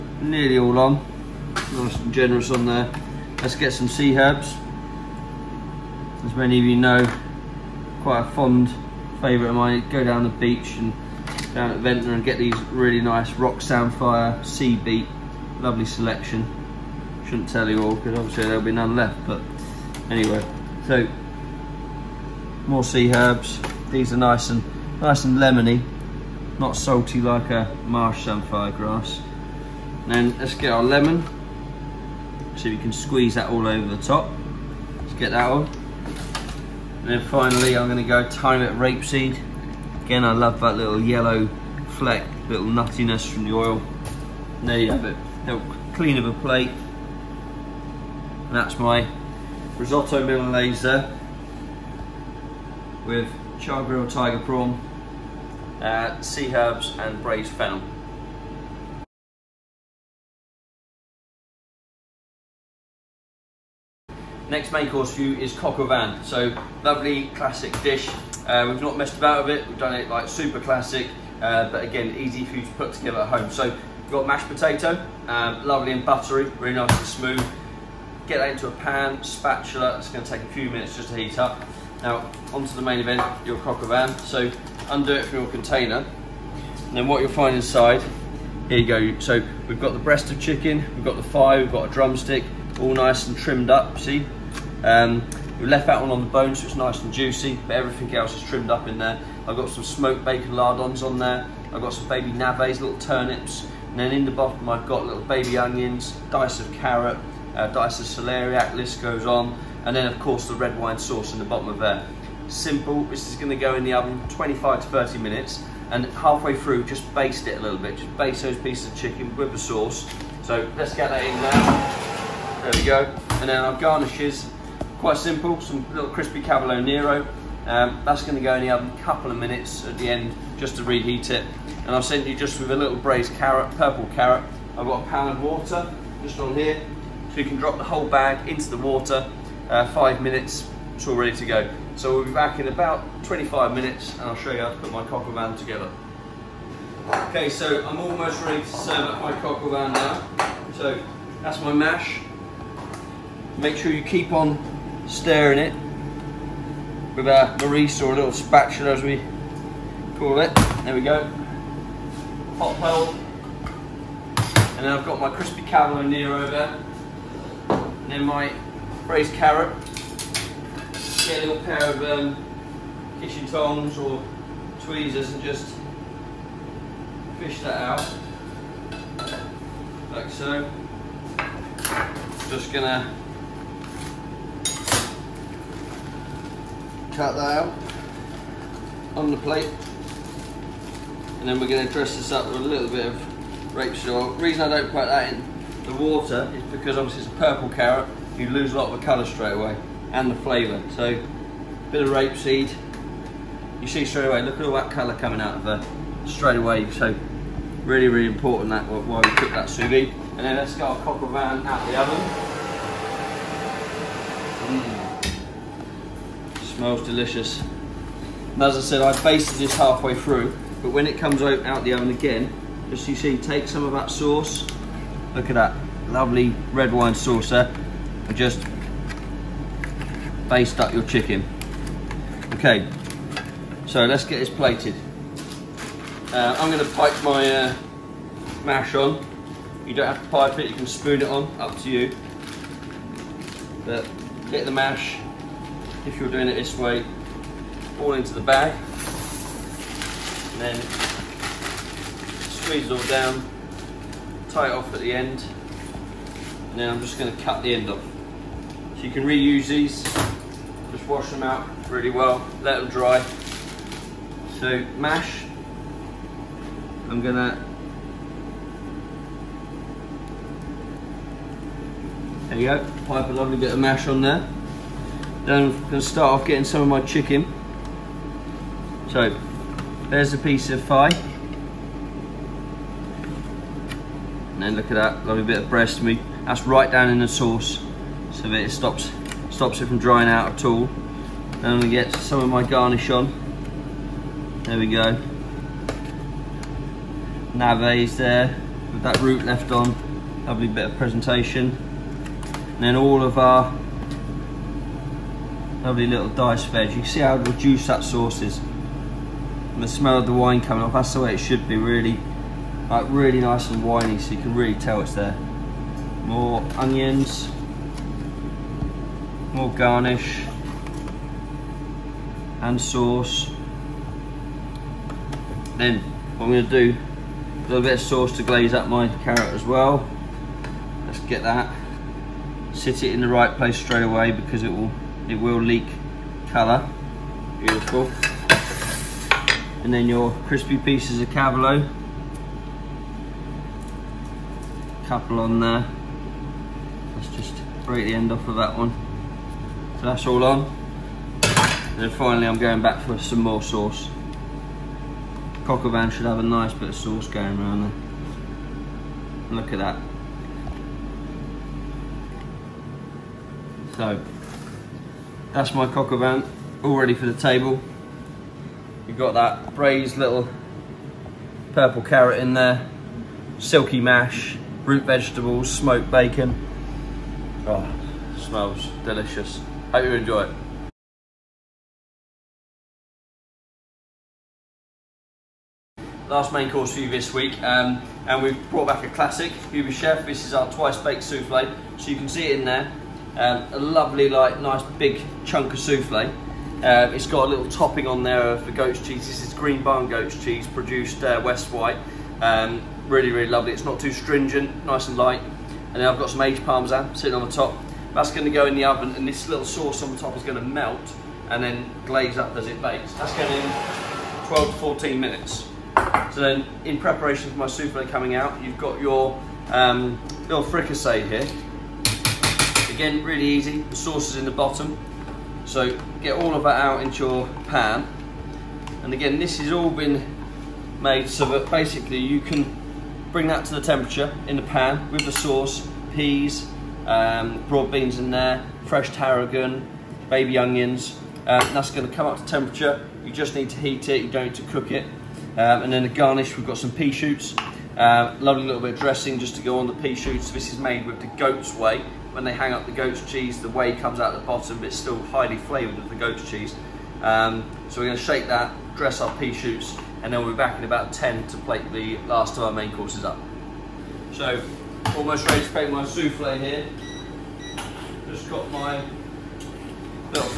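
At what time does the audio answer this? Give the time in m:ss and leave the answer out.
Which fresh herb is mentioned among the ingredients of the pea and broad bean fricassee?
7:18.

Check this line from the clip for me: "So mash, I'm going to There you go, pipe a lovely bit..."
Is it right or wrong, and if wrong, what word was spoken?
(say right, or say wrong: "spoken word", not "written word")
right.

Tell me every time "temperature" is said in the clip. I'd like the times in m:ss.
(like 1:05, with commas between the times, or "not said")
7:13, 7:22.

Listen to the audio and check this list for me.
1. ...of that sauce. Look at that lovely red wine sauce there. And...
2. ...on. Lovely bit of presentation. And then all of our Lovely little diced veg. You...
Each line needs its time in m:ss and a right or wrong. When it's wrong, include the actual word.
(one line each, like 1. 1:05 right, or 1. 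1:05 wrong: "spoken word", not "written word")
1. 3:43 right
2. 4:59 right.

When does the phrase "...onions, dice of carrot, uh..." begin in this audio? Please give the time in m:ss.
1:45.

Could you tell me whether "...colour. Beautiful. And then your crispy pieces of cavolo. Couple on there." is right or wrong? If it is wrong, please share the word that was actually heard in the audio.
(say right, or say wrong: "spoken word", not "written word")
right.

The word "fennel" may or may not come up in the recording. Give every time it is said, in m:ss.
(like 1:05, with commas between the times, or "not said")
0:57.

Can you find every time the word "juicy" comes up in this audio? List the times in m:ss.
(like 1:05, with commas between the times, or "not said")
1:37.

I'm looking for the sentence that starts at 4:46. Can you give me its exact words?
That's right down in the sauce so that it stops, stops it from drying out at all.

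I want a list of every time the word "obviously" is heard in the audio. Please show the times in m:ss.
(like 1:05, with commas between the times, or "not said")
0:18, 3:16.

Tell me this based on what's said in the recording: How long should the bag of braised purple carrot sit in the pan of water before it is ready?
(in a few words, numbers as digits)
5 minutes.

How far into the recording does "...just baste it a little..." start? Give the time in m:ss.
1:56.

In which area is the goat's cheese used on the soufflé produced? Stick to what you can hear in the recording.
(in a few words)
West Wight.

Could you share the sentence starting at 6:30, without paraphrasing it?
This is our twice baked souffle.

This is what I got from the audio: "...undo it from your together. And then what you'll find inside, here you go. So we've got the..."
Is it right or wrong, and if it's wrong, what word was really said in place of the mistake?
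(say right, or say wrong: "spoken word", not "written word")
wrong: "container", not "together".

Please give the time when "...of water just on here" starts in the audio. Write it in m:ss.
2:15.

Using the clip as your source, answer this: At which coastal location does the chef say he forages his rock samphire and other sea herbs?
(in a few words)
Ventnor.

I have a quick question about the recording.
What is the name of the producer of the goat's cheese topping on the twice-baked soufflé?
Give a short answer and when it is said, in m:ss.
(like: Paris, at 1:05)
Green Barn, at 6:39.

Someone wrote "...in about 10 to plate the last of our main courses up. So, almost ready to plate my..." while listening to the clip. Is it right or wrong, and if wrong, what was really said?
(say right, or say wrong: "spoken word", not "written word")
right.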